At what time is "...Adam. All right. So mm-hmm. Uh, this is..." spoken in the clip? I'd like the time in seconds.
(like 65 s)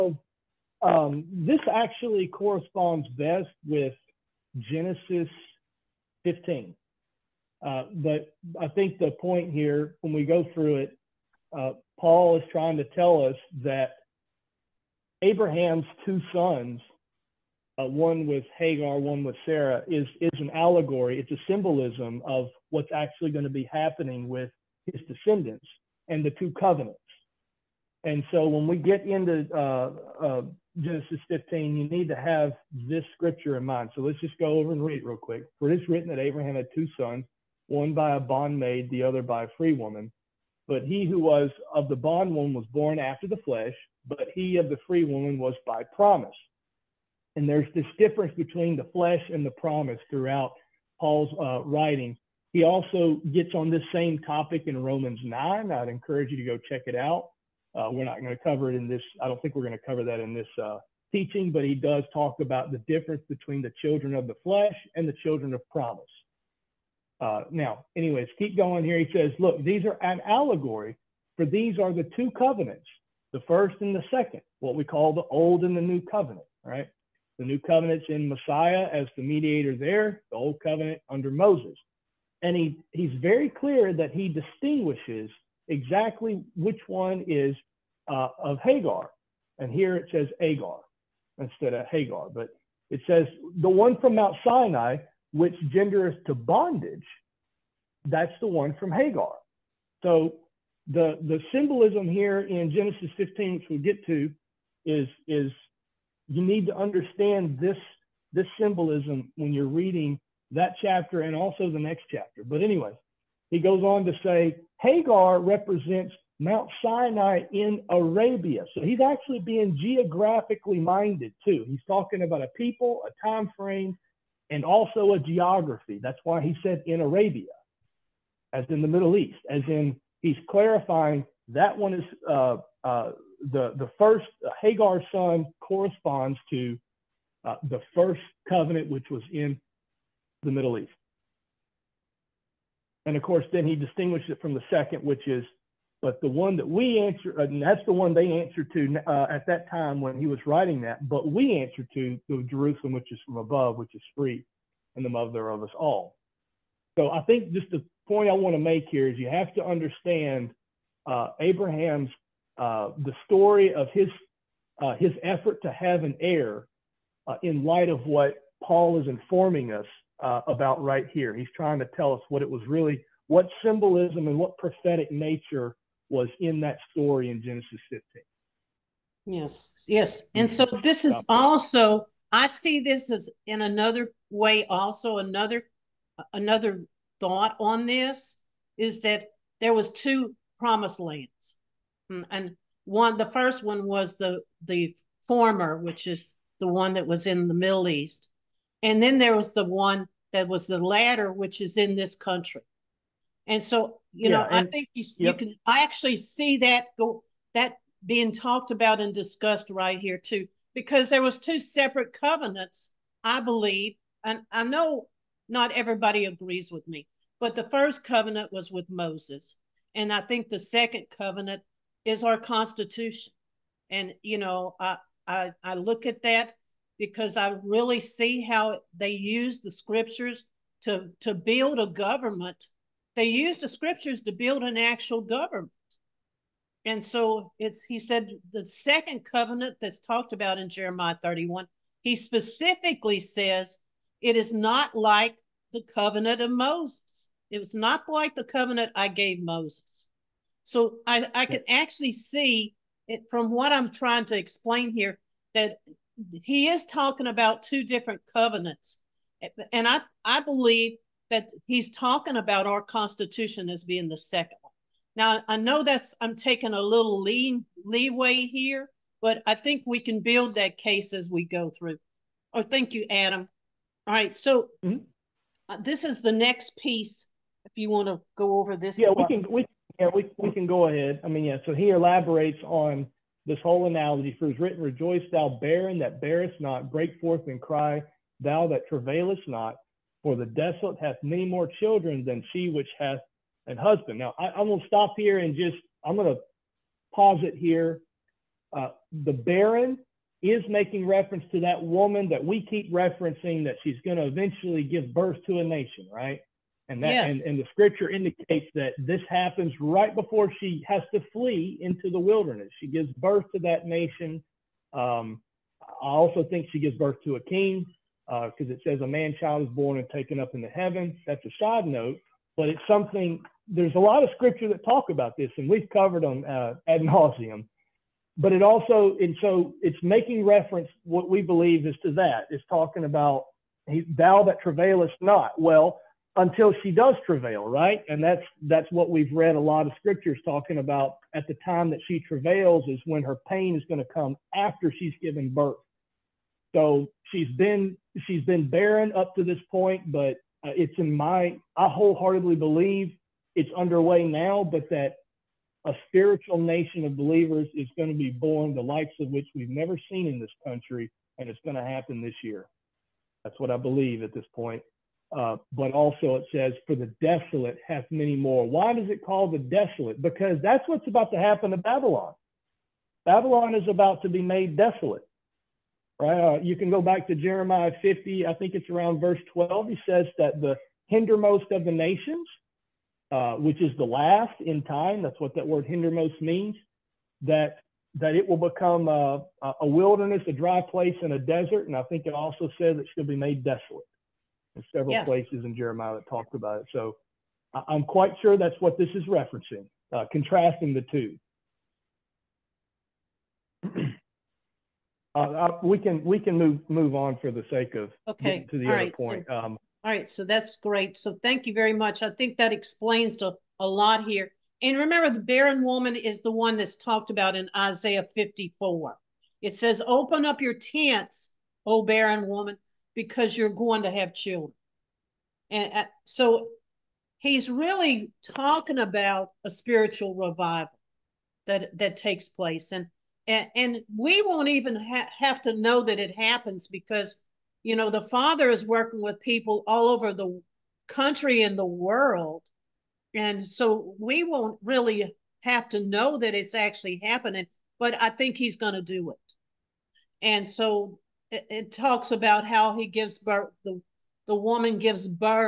273 s.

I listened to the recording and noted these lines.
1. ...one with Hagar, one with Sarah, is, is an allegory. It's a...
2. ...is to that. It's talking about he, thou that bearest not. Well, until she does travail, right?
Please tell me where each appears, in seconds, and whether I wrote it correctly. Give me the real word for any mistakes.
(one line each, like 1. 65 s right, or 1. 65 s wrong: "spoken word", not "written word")
1. 17 s right
2. 331 s wrong: "travailest", not "bearest".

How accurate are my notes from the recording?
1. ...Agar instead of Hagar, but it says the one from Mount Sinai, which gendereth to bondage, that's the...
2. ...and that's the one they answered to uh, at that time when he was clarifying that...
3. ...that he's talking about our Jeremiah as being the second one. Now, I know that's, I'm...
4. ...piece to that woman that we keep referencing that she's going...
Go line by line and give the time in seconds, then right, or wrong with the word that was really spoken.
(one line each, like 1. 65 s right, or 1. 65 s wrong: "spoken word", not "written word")
1. 90 s right
2. 147 s wrong: "writing", not "clarifying"
3. 261 s wrong: "Constitution", not "Jeremiah"
4. 301 s wrong: "reference", not "piece".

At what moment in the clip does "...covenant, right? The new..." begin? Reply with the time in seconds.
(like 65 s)
76 s.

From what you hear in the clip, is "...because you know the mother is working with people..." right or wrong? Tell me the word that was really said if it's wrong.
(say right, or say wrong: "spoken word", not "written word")
wrong: "father", not "mother".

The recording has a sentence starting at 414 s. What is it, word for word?
And remember, the barren woman is the one that's talked about in Isaiah 54.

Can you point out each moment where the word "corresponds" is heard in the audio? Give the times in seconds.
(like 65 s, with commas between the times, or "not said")
2 s, 135 s.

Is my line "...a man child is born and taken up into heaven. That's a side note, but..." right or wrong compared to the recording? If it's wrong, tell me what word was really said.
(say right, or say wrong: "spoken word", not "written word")
right.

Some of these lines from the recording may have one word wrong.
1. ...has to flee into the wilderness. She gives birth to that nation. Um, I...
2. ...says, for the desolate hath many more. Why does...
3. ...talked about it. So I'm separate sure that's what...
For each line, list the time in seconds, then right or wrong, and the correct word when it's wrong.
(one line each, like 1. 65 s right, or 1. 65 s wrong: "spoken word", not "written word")
1. 310 s right
2. 366 s right
3. 396 s wrong: "quite", not "separate".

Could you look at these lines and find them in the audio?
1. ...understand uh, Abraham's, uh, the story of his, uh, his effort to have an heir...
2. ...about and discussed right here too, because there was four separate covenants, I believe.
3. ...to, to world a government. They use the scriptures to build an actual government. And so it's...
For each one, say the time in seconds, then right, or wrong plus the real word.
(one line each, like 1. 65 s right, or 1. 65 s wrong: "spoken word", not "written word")
1. 159 s right
2. 208 s wrong: "two", not "four"
3. 230 s wrong: "build", not "world".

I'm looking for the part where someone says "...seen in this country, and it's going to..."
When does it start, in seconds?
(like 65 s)
360 s.